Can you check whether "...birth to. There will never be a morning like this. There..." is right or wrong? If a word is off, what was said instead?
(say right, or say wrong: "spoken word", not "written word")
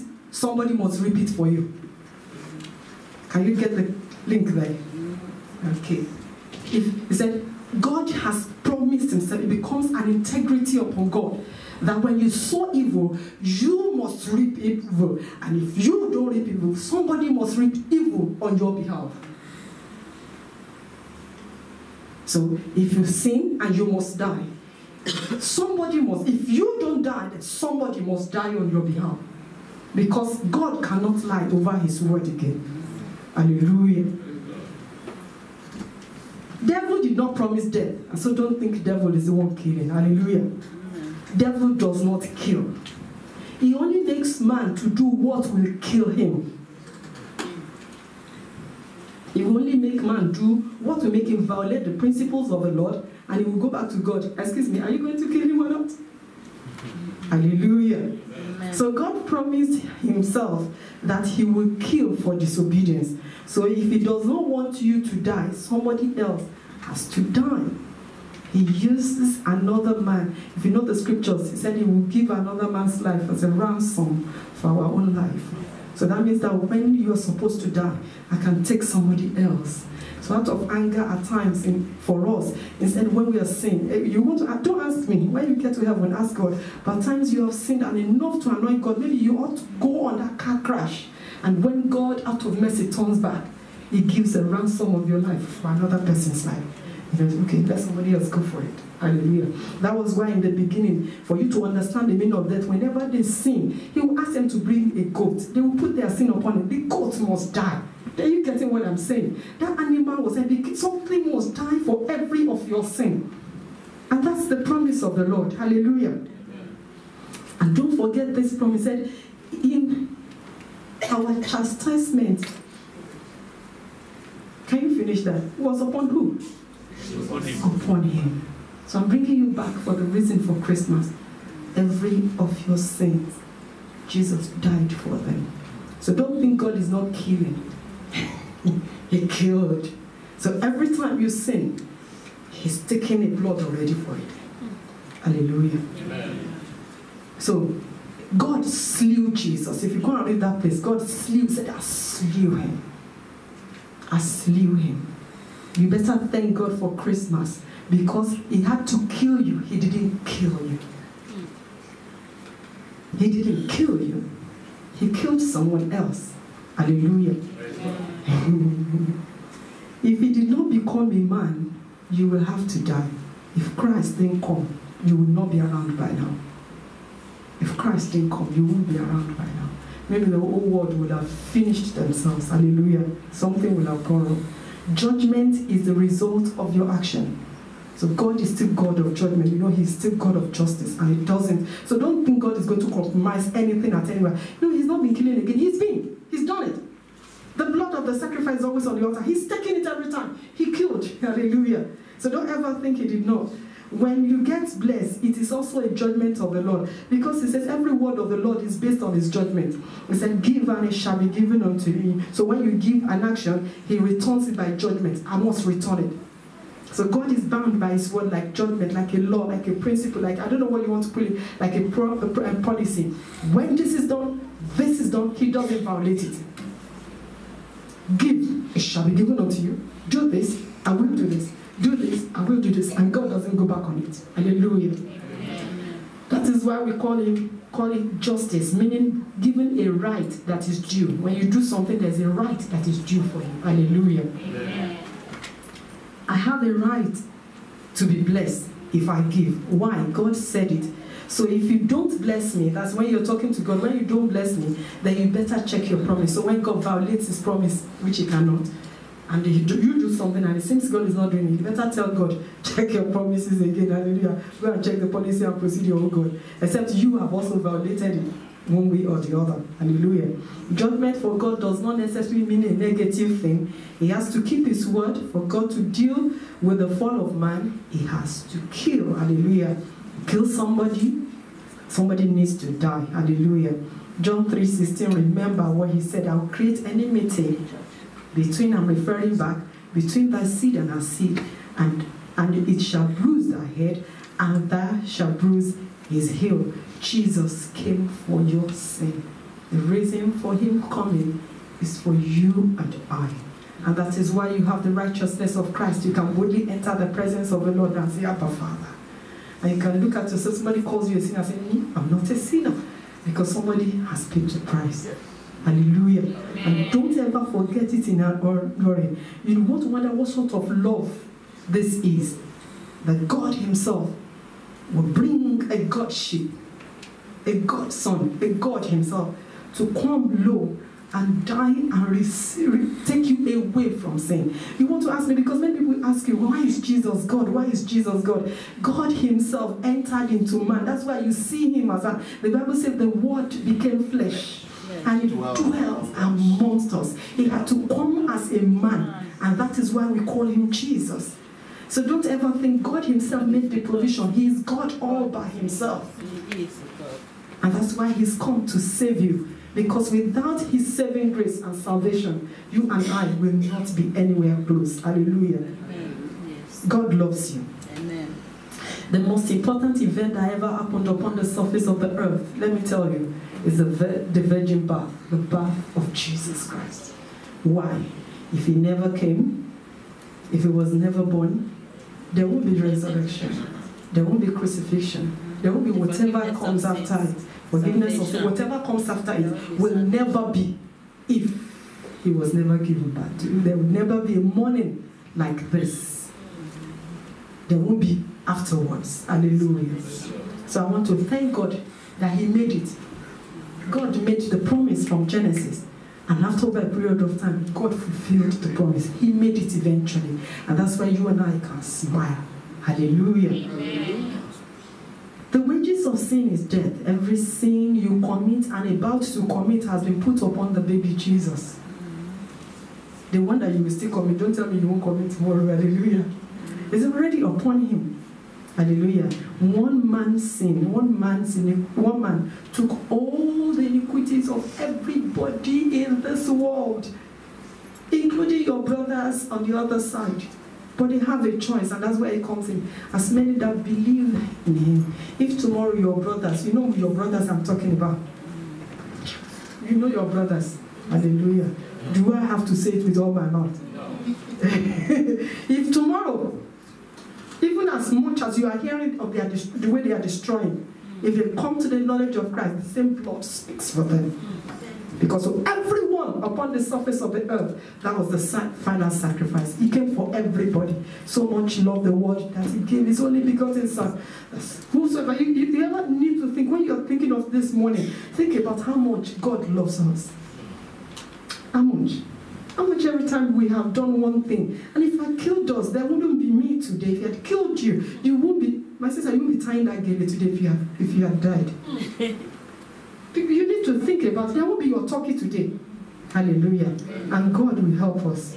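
right.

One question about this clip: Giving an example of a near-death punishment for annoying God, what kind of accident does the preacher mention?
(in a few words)
car crash.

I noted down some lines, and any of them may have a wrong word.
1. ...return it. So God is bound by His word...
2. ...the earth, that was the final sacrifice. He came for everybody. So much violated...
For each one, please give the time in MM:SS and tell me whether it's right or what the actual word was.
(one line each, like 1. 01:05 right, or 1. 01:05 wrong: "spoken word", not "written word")
1. 03:35 right
2. 07:47 wrong: "loved", not "violated".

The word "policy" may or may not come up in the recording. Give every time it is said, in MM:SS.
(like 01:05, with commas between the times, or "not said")
03:42, 04:25.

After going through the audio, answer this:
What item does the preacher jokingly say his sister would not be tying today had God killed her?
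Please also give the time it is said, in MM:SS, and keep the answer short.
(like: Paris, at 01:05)
gele, at 08:10.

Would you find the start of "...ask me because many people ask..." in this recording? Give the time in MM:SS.
05:35.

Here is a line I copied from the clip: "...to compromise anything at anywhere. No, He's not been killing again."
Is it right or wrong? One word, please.
right.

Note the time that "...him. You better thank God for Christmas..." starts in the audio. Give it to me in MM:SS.
02:34.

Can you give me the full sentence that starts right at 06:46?
And after a period of time, God fulfilled the promise.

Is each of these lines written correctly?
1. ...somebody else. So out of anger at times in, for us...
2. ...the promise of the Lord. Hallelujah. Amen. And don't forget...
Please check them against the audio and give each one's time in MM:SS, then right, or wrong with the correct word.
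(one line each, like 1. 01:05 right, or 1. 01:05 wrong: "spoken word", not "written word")
1. 01:18 right
2. 01:54 right.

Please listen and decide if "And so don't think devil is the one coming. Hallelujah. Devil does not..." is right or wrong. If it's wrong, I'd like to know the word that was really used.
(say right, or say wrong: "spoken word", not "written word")
wrong: "killing", not "coming".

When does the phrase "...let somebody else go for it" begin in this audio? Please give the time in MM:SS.
01:37.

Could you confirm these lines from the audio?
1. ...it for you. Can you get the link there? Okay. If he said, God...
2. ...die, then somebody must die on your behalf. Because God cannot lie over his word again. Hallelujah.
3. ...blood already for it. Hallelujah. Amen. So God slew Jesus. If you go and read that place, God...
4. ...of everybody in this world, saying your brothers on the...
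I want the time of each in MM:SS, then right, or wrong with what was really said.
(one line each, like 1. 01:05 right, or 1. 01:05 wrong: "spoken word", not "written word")
1. 00:01 right
2. 00:27 right
3. 02:23 right
4. 07:14 wrong: "including", not "saying".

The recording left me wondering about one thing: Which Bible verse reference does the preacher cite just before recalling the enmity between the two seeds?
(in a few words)
John 3:16.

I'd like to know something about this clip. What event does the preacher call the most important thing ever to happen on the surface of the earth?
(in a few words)
the virgin birth.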